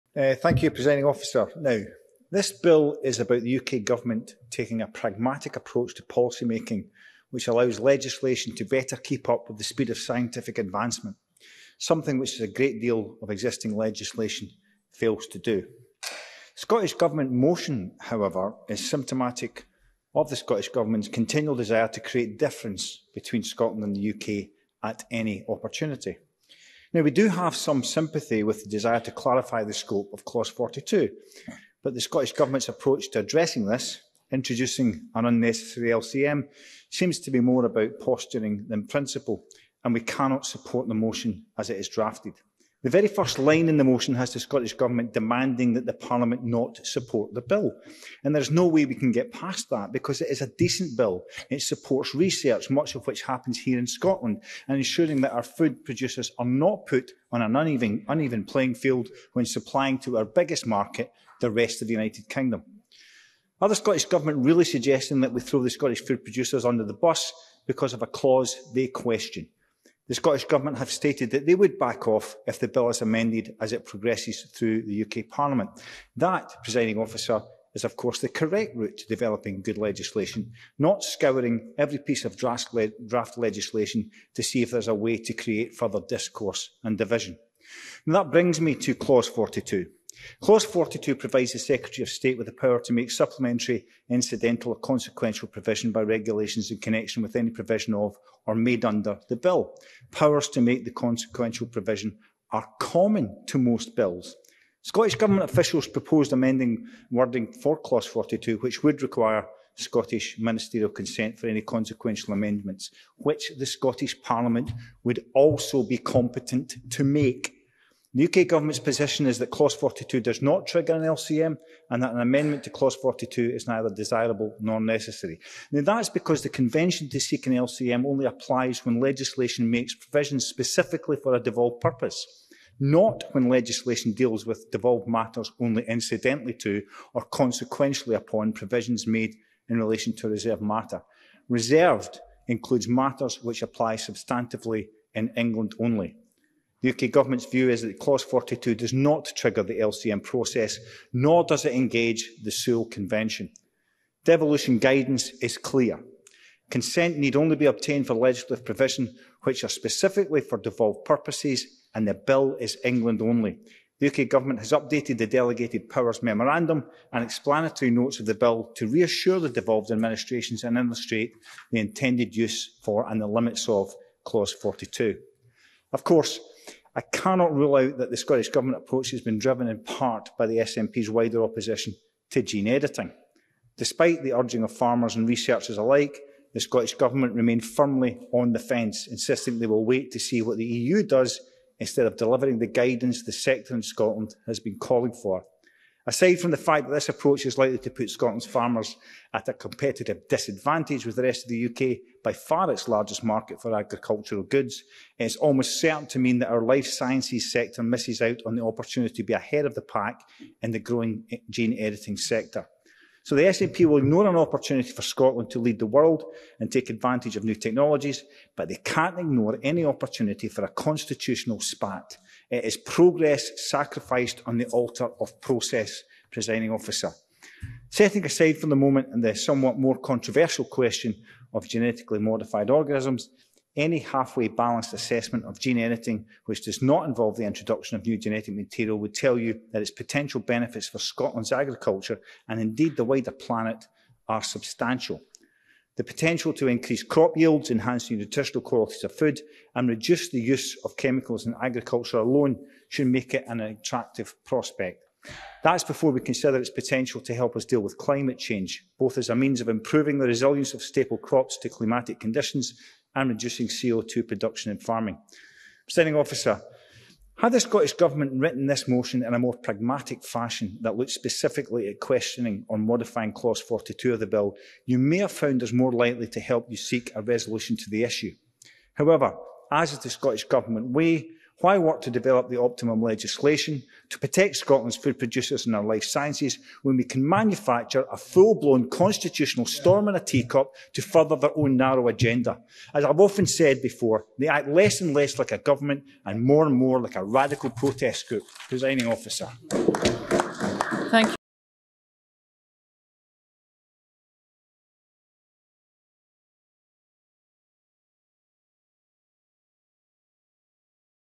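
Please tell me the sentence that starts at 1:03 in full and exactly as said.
Are the Scottish Government really suggesting that we throw the Scottish food producers under the bus because of a clause they question?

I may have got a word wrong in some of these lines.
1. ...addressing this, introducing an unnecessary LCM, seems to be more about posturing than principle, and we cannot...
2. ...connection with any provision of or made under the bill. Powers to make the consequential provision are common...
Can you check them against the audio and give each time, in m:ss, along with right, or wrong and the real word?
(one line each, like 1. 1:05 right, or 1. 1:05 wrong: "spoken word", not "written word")
1. 0:33 right
2. 1:36 right.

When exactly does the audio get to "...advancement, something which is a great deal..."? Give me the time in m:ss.
0:10.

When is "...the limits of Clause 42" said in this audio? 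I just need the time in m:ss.
2:53.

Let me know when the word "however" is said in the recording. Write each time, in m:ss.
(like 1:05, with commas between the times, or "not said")
0:18, 4:38.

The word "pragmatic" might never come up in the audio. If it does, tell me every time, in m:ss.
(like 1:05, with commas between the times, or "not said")
0:04, 4:29.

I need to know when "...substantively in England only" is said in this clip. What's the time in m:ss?
2:23.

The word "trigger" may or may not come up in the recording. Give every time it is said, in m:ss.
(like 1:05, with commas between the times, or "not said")
2:00, 2:29.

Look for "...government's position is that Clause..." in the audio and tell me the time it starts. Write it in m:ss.
1:58.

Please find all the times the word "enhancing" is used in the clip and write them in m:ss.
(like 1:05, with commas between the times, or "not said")
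4:07.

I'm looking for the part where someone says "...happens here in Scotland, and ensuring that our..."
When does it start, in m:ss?
0:53.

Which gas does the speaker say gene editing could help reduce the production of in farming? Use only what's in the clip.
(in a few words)
CO2.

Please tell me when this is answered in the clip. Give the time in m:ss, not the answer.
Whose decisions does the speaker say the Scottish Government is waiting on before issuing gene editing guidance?
3:10.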